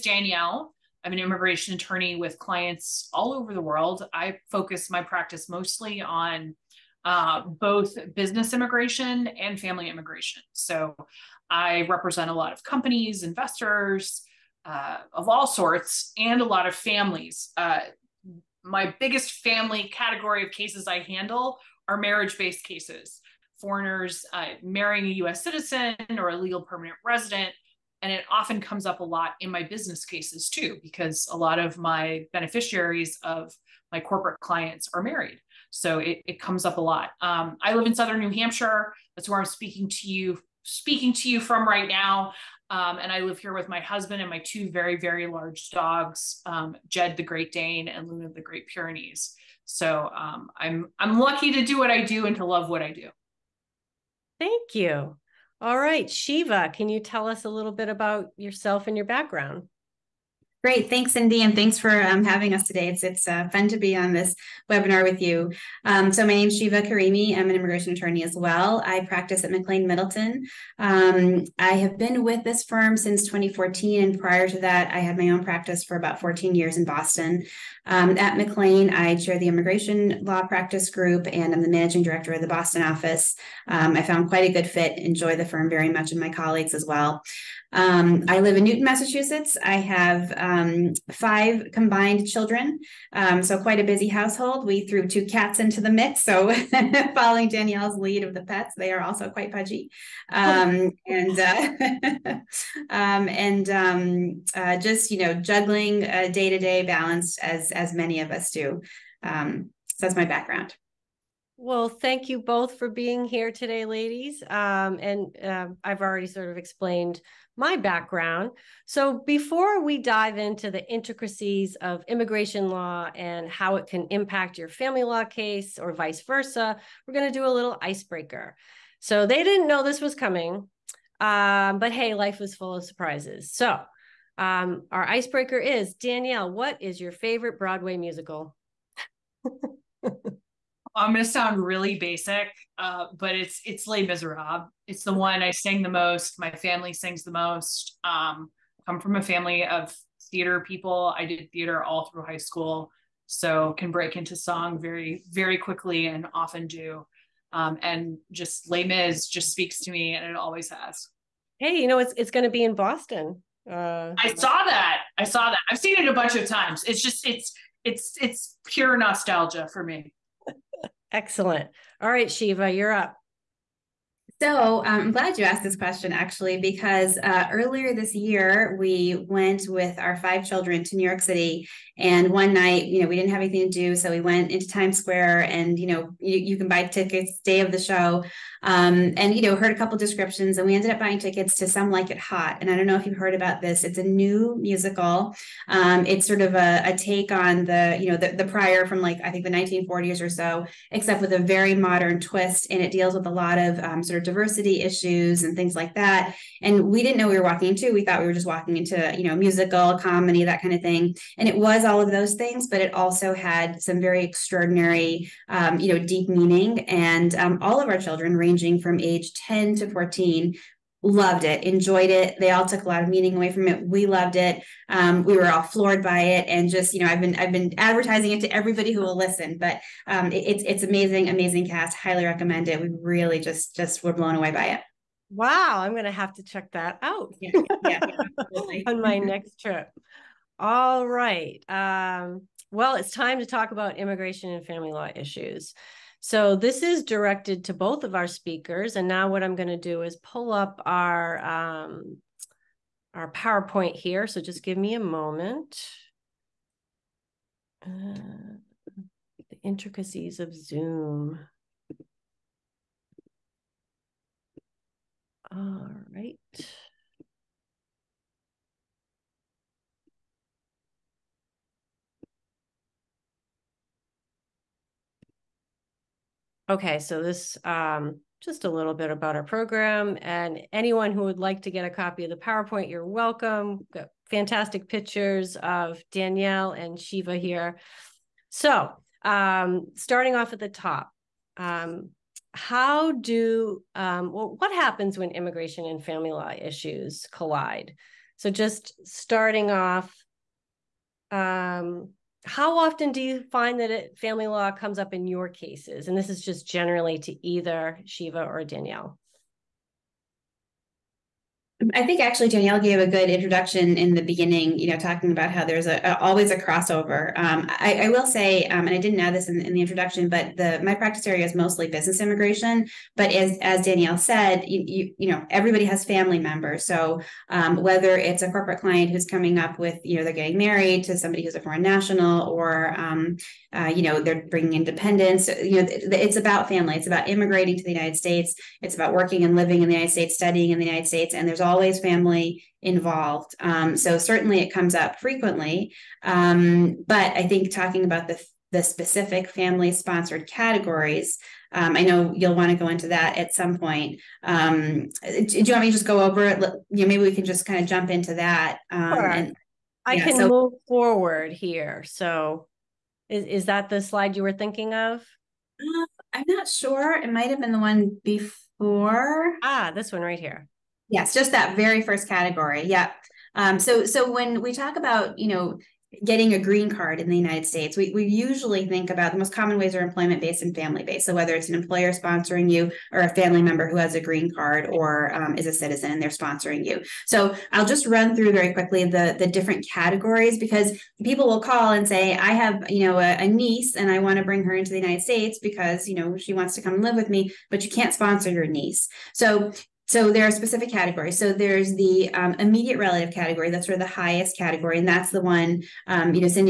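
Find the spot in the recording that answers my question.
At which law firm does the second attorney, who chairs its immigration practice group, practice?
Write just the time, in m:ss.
1:09.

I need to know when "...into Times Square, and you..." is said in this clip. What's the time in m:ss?
3:04.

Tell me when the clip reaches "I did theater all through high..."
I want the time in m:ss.
2:31.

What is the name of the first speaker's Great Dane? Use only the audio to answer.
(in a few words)
Jed.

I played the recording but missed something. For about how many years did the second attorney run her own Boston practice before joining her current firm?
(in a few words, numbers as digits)
14.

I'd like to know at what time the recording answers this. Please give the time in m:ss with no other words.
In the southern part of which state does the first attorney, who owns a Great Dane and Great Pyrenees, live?
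0:37.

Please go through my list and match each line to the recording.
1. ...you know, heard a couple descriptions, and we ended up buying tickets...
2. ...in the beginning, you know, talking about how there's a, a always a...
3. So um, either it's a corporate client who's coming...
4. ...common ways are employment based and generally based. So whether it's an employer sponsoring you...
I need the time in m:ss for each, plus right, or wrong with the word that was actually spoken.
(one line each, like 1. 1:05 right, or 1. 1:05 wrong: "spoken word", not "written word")
1. 3:09 right
2. 5:13 right
3. 5:26 wrong: "whether", not "either"
4. 6:19 wrong: "family", not "generally".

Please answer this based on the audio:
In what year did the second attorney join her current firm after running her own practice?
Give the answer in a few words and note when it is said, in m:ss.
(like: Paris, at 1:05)
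2014, at 1:13.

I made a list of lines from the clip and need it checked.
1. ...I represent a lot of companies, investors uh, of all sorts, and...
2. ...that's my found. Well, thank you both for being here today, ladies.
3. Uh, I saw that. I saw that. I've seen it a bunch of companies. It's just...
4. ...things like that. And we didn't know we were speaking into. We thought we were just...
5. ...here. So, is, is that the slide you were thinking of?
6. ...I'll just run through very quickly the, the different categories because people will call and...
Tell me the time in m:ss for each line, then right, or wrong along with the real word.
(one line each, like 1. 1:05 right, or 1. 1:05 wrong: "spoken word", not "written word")
1. 0:11 right
2. 1:49 wrong: "background", not "found"
3. 2:43 wrong: "times", not "companies"
4. 3:25 wrong: "walking", not "speaking"
5. 6:01 right
6. 6:27 right.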